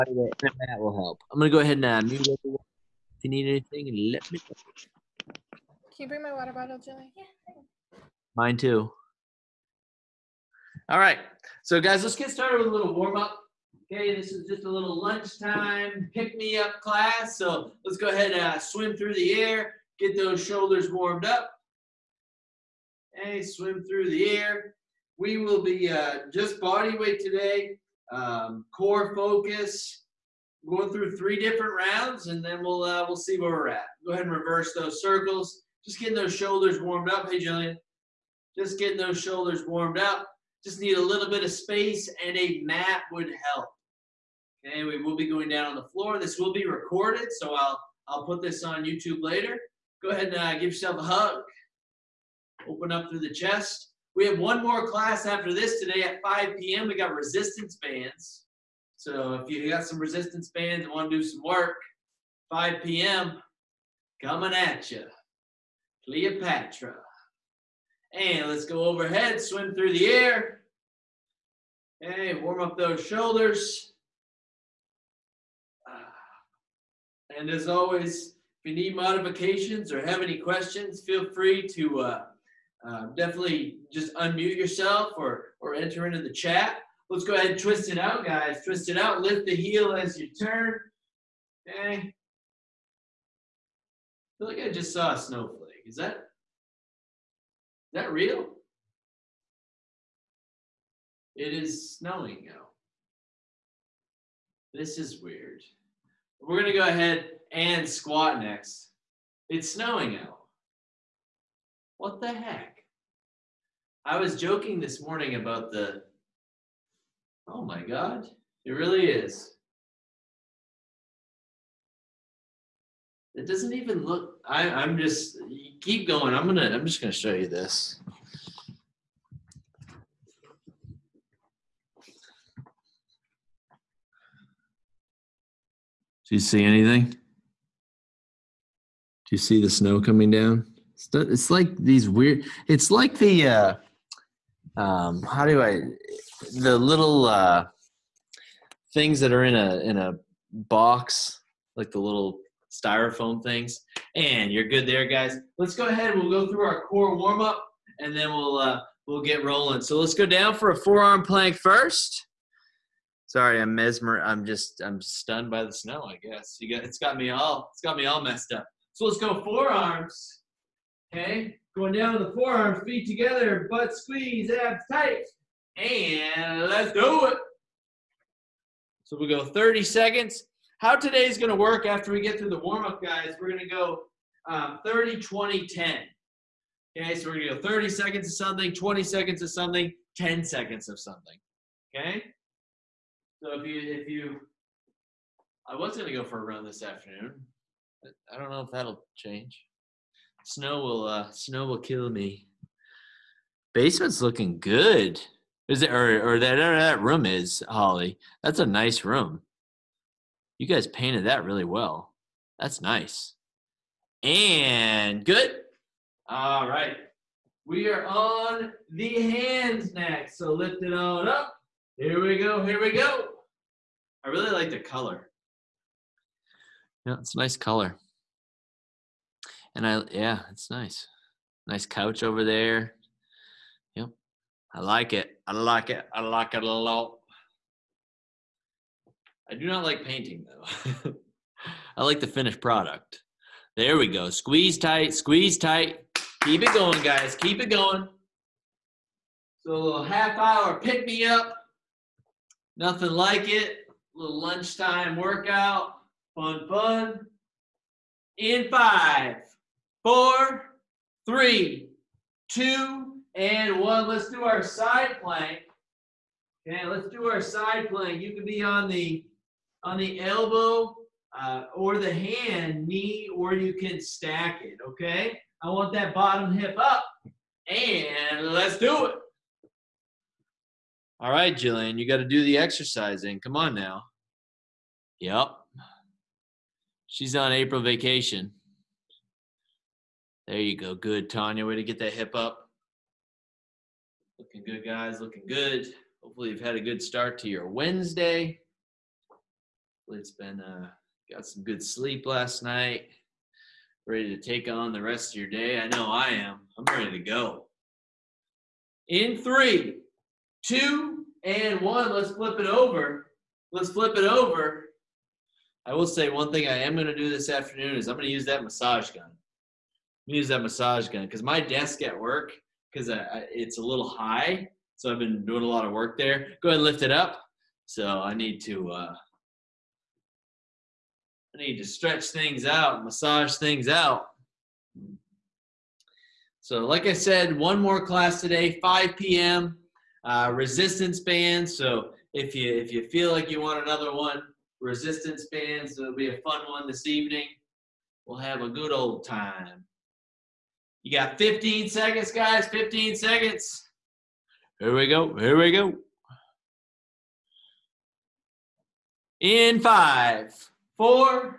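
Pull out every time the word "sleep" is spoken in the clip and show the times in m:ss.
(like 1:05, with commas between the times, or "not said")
5:01.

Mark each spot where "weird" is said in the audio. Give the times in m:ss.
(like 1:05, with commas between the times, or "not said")
1:45, 2:22.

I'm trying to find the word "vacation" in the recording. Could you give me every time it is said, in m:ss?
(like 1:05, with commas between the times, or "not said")
4:47.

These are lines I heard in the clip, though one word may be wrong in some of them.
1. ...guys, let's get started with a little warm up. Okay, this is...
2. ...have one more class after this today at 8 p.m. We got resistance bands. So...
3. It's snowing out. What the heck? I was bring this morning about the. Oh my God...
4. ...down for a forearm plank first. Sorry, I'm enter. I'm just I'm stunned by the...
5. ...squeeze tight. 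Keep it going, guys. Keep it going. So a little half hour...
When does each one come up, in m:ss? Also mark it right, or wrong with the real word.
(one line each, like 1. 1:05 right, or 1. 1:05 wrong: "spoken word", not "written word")
1. 0:11 right
2. 0:54 wrong: "5", not "8"
3. 1:49 wrong: "joking", not "bring"
4. 2:40 wrong: "mesmer", not "enter"
5. 4:05 right.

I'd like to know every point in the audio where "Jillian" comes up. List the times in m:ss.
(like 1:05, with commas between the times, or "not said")
0:06, 0:37, 4:41.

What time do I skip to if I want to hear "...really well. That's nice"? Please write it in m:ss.
3:31.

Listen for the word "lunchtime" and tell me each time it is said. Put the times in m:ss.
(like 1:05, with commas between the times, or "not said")
0:15, 4:14.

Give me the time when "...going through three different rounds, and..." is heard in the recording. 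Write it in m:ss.
0:30.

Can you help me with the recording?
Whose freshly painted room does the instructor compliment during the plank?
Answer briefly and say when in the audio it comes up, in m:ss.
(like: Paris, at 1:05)
Holly, at 3:27.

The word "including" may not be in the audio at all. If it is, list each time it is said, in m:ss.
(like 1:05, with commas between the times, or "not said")
not said.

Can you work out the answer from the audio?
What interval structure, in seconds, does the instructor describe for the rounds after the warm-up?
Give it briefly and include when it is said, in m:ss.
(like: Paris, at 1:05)
30, 20, 10, at 3:04.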